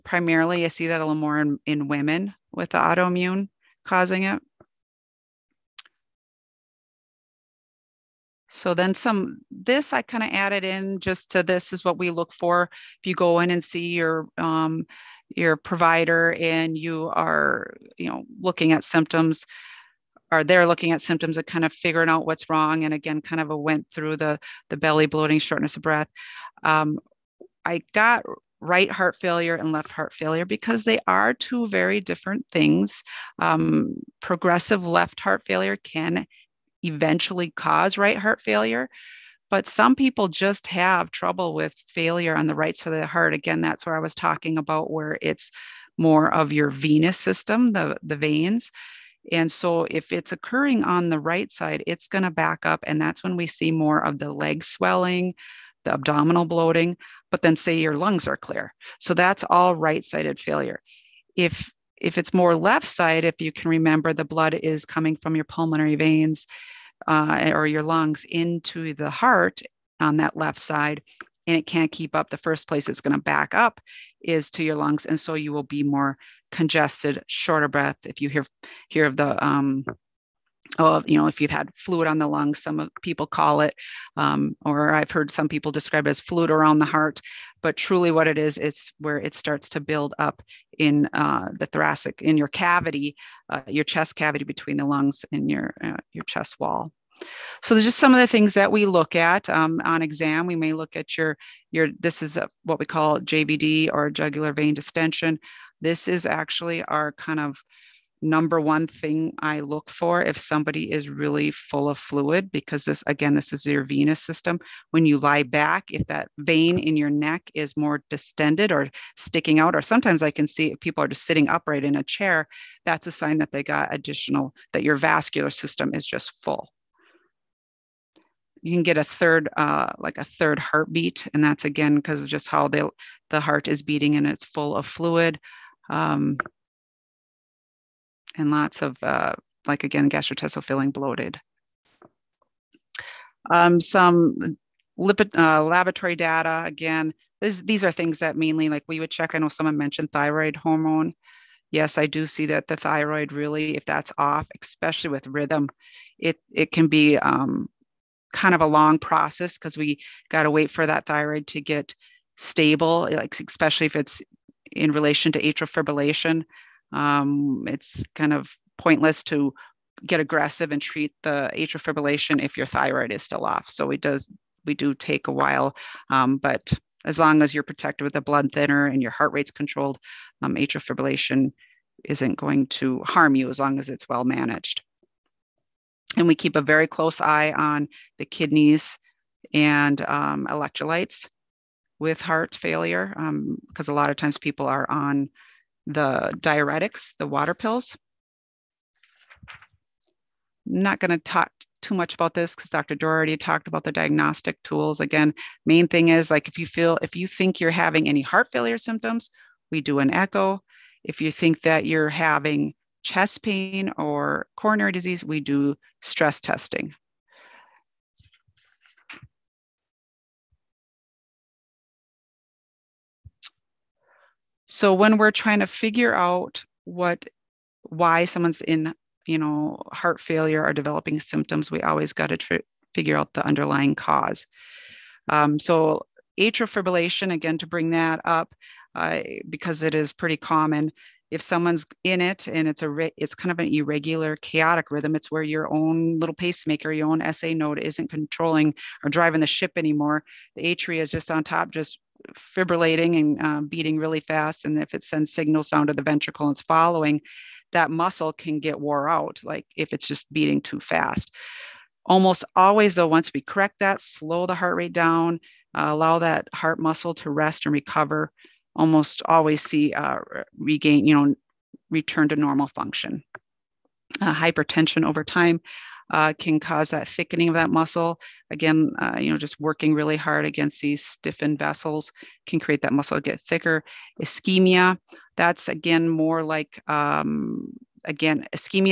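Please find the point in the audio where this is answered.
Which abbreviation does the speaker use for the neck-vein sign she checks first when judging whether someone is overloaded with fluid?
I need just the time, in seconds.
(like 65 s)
103 s.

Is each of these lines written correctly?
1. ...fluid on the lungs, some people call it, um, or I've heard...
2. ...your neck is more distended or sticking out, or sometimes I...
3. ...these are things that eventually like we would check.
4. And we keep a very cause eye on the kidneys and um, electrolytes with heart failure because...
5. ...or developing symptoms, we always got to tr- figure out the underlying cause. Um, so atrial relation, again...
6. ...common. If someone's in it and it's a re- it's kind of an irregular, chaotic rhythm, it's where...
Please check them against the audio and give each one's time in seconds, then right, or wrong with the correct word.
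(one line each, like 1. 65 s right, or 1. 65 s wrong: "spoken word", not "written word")
1. 81 s right
2. 116 s right
3. 147 s wrong: "mainly", not "eventually"
4. 186 s wrong: "close", not "cause"
5. 230 s wrong: "fibrillation", not "relation"
6. 240 s right.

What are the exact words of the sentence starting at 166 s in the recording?
Um, it's kind of pointless to get aggressive and treat the atrial fibrillation if your thyroid is still off.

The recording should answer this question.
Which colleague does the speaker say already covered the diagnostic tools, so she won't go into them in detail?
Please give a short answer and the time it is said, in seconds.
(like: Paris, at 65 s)
Dr. Doherty, at 202 s.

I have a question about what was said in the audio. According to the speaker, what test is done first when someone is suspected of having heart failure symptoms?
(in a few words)
Echo.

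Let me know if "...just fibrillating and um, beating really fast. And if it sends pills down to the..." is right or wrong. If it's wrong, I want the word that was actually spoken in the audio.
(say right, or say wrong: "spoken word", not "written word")
wrong: "signals", not "pills".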